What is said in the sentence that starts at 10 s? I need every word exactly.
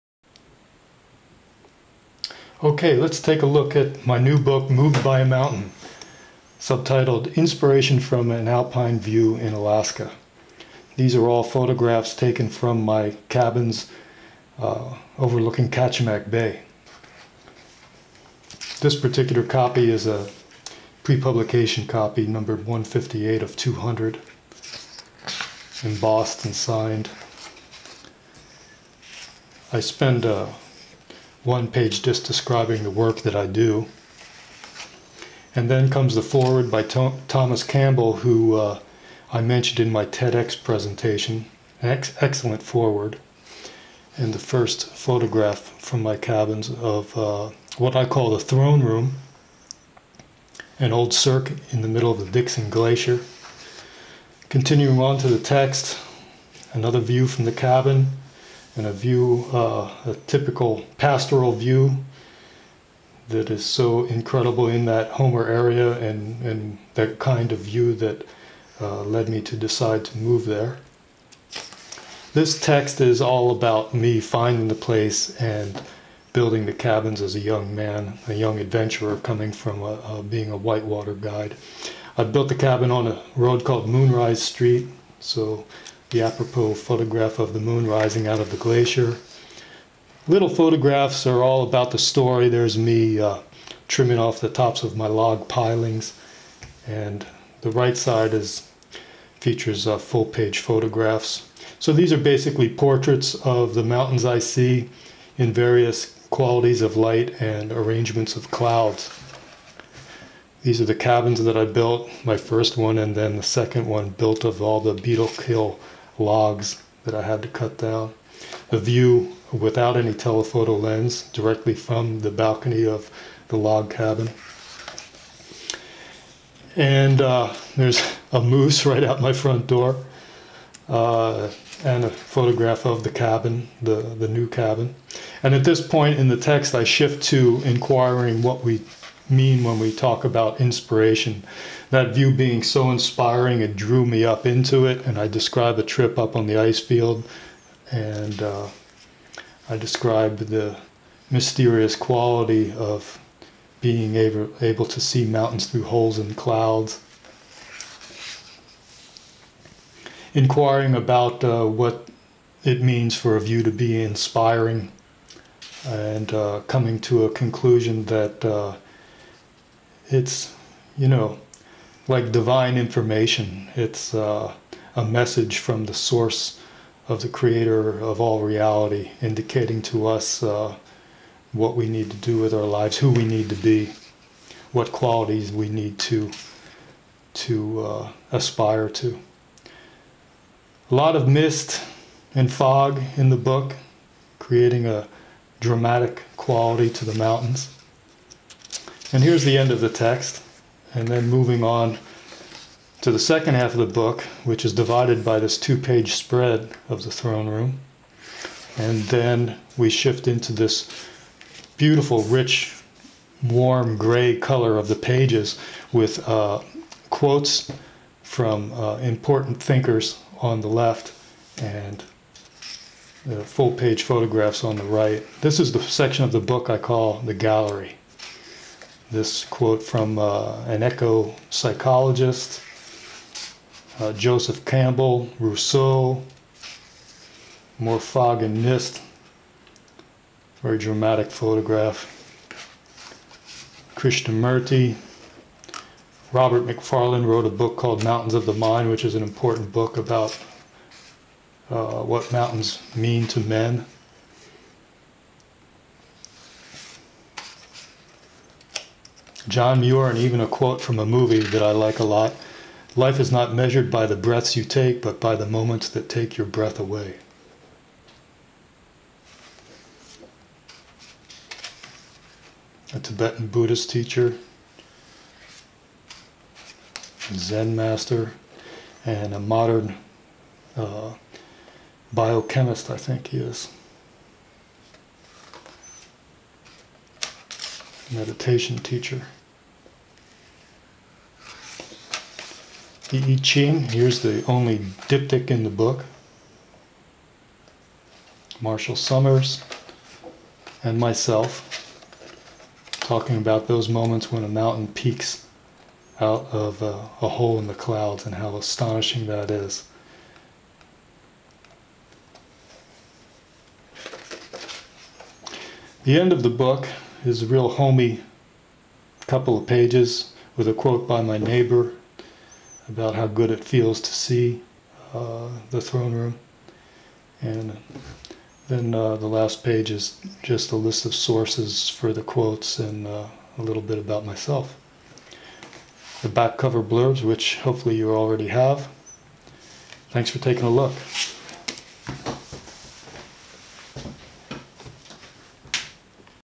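These are all photographs taken from my cabins uh, overlooking Kachemak Bay.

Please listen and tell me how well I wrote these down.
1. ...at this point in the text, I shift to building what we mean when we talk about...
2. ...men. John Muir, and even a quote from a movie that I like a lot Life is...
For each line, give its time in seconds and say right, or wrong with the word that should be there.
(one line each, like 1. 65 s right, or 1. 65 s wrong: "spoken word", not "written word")
1. 135 s wrong: "inquiring", not "building"
2. 253 s right.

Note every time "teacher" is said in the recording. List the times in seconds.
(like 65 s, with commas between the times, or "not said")
273 s, 288 s.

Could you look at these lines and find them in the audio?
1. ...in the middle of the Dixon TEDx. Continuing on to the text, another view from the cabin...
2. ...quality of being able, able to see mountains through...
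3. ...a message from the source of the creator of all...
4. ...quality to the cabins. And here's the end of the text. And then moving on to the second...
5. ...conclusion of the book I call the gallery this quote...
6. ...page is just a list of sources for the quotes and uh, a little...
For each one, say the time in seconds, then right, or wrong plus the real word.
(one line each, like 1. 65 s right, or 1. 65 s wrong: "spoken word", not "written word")
1. 51 s wrong: "Glacier", not "TEDx"
2. 151 s right
3. 174 s right
4. 196 s wrong: "mountains", not "cabins"
5. 225 s wrong: "section", not "conclusion"
6. 329 s right.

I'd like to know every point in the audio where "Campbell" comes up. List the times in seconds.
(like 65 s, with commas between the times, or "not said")
37 s, 234 s.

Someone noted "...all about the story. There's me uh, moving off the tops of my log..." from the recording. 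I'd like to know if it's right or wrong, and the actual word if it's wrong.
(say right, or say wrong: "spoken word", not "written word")
wrong: "trimming", not "moving".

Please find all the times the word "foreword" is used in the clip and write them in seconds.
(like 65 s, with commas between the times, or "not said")
36 s, 42 s.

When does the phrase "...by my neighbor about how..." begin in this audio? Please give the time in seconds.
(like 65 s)
321 s.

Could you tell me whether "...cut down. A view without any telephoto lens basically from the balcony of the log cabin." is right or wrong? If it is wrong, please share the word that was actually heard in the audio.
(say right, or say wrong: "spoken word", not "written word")
wrong: "directly", not "basically".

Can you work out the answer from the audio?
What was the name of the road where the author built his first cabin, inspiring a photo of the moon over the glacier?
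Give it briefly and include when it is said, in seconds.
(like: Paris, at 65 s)
Moonrise Street, at 83 s.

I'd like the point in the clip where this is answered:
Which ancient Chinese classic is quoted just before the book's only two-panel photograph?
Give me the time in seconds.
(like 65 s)
293 s.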